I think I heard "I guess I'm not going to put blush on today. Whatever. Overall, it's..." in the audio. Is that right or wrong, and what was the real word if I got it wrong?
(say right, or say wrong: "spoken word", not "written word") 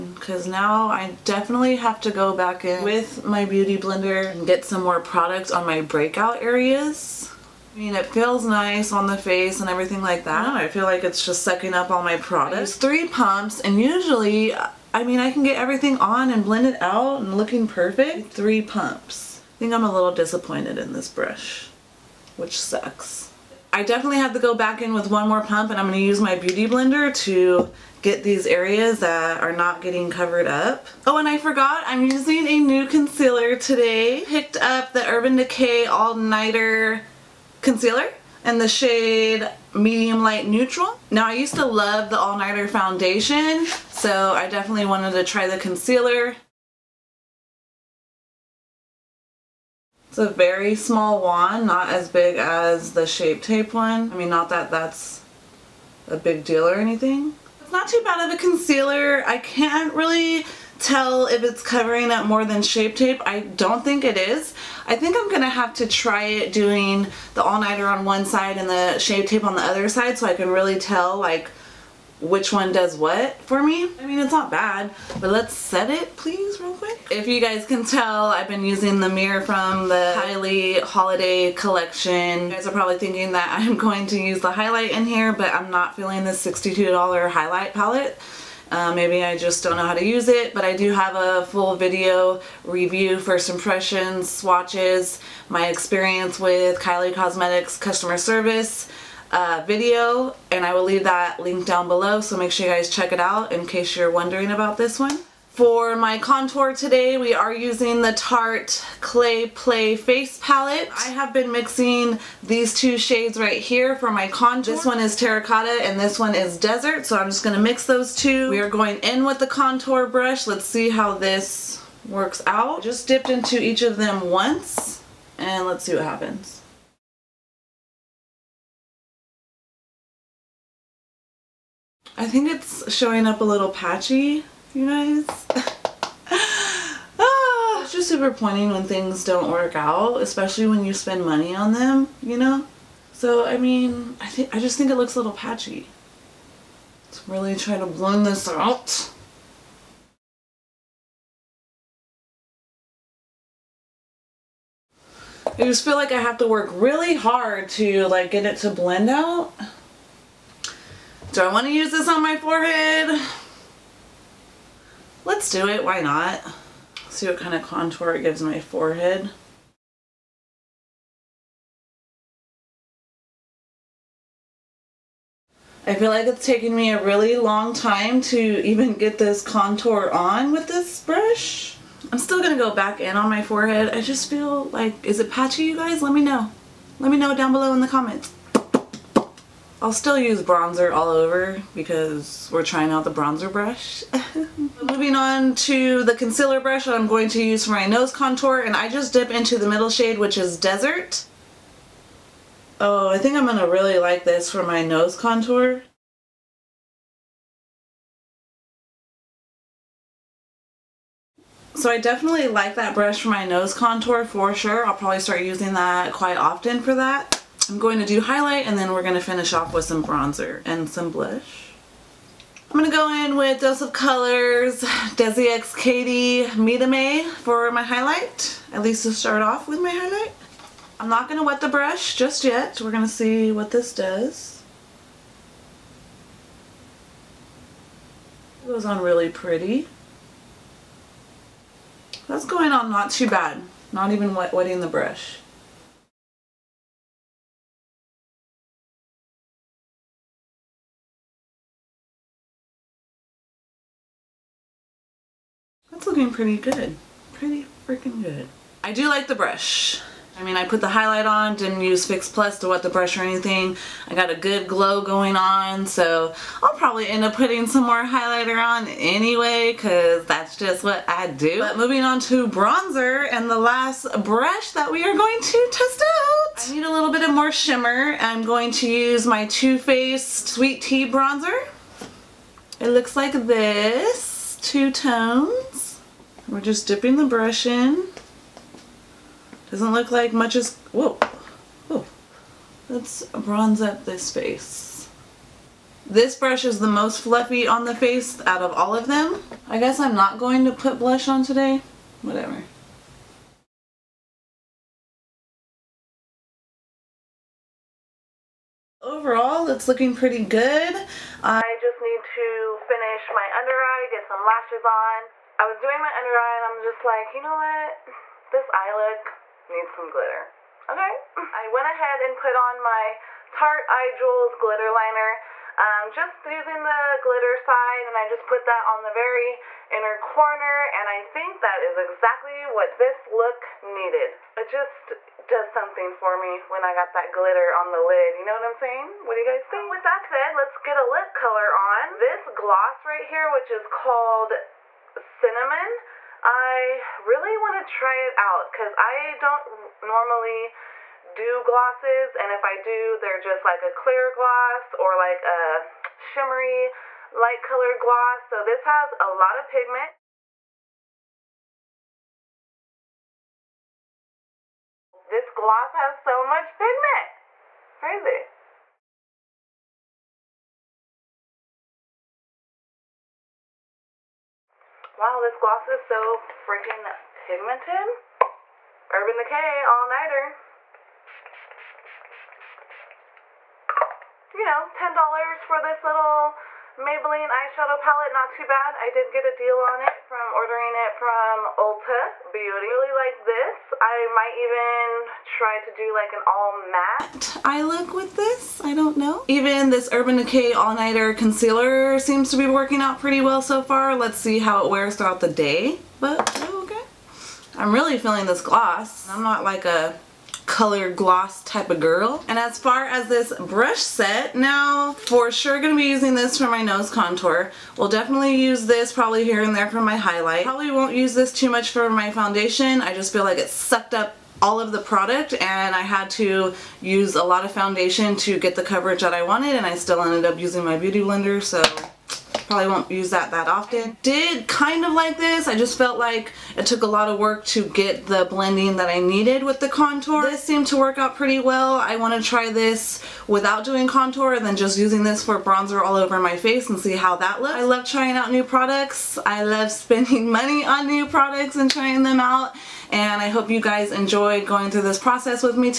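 right.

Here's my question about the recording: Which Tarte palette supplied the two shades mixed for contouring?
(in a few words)
Clay Play Face Palette.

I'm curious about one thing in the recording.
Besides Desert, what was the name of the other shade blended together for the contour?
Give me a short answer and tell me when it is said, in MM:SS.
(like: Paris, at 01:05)
Terracotta, at 01:55.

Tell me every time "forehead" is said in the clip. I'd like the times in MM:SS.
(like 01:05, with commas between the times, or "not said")
02:42, 02:48, 03:03.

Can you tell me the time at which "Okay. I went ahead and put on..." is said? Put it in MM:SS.
05:20.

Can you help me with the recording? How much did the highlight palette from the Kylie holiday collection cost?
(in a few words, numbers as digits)
$62.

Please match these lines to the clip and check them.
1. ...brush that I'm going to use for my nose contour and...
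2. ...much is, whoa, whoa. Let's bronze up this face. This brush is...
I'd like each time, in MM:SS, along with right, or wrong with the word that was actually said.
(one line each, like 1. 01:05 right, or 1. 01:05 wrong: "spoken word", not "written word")
1. 03:16 right
2. 04:50 right.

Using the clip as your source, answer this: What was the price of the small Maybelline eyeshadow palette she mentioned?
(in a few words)
$10.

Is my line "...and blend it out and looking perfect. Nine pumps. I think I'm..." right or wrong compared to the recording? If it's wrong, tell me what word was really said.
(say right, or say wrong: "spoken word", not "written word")
wrong: "Three", not "Nine".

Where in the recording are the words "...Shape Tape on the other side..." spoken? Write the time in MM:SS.
01:08.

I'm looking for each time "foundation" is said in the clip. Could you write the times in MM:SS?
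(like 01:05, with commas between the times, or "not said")
00:42, 07:02, 07:07.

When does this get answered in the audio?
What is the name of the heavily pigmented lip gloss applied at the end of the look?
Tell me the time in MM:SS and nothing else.
05:45.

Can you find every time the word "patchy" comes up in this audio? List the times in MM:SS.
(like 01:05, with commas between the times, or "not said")
02:13, 02:25, 03:05.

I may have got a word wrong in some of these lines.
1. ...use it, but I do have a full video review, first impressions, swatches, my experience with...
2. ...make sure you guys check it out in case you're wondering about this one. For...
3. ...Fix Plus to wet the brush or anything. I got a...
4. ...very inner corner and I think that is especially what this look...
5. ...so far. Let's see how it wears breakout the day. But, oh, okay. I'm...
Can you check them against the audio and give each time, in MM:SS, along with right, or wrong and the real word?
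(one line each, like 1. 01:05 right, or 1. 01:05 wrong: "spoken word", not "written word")
1. 01:30 right
2. 01:42 right
3. 04:22 right
4. 05:29 wrong: "exactly", not "especially"
5. 06:43 wrong: "throughout", not "breakout".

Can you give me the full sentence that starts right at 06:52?
And as far as this brush set, now for sure gonna be using this for my nose contour.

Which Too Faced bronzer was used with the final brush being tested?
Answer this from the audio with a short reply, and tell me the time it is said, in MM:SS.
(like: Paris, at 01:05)
Sweet Tea, at 04:40.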